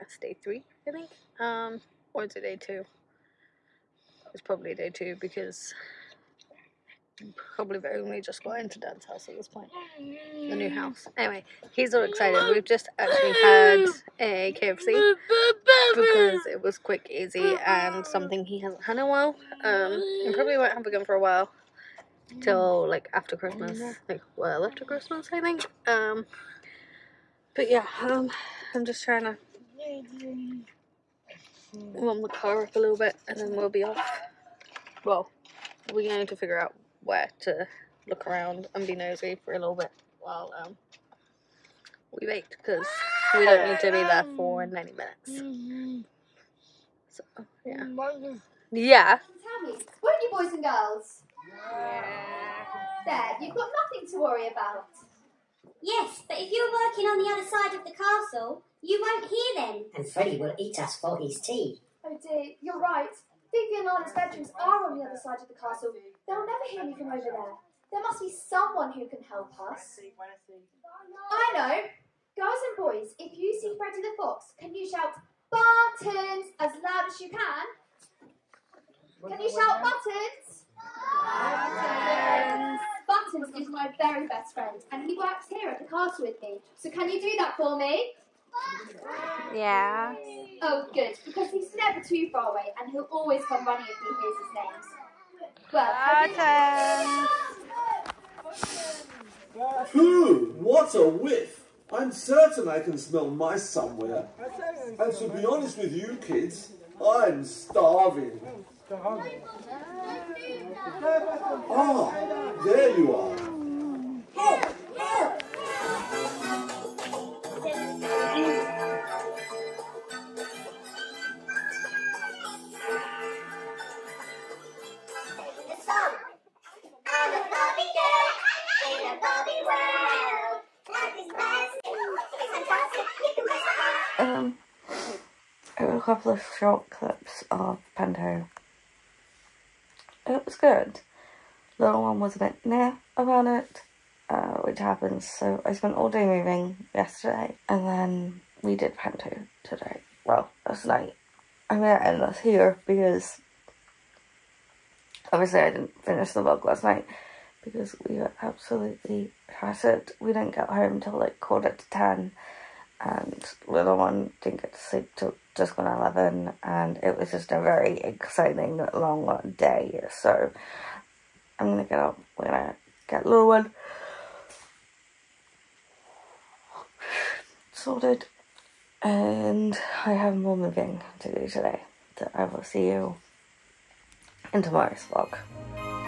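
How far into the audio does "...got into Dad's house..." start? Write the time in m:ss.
0:08.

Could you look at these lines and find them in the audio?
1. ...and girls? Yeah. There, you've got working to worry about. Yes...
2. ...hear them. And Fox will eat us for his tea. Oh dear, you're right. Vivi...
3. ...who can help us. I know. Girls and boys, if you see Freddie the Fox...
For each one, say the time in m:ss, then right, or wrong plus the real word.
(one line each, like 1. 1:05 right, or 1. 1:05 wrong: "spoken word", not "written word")
1. 0:50 wrong: "nothing", not "working"
2. 0:59 wrong: "Freddy", not "Fox"
3. 1:08 right.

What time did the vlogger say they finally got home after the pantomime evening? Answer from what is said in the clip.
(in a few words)
Quarter to ten.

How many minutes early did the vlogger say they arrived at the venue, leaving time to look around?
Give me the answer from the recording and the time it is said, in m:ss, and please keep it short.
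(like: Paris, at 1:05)
90, at 0:44.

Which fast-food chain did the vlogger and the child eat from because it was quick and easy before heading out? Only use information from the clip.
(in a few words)
KFC.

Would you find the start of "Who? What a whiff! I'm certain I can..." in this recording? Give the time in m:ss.
1:39.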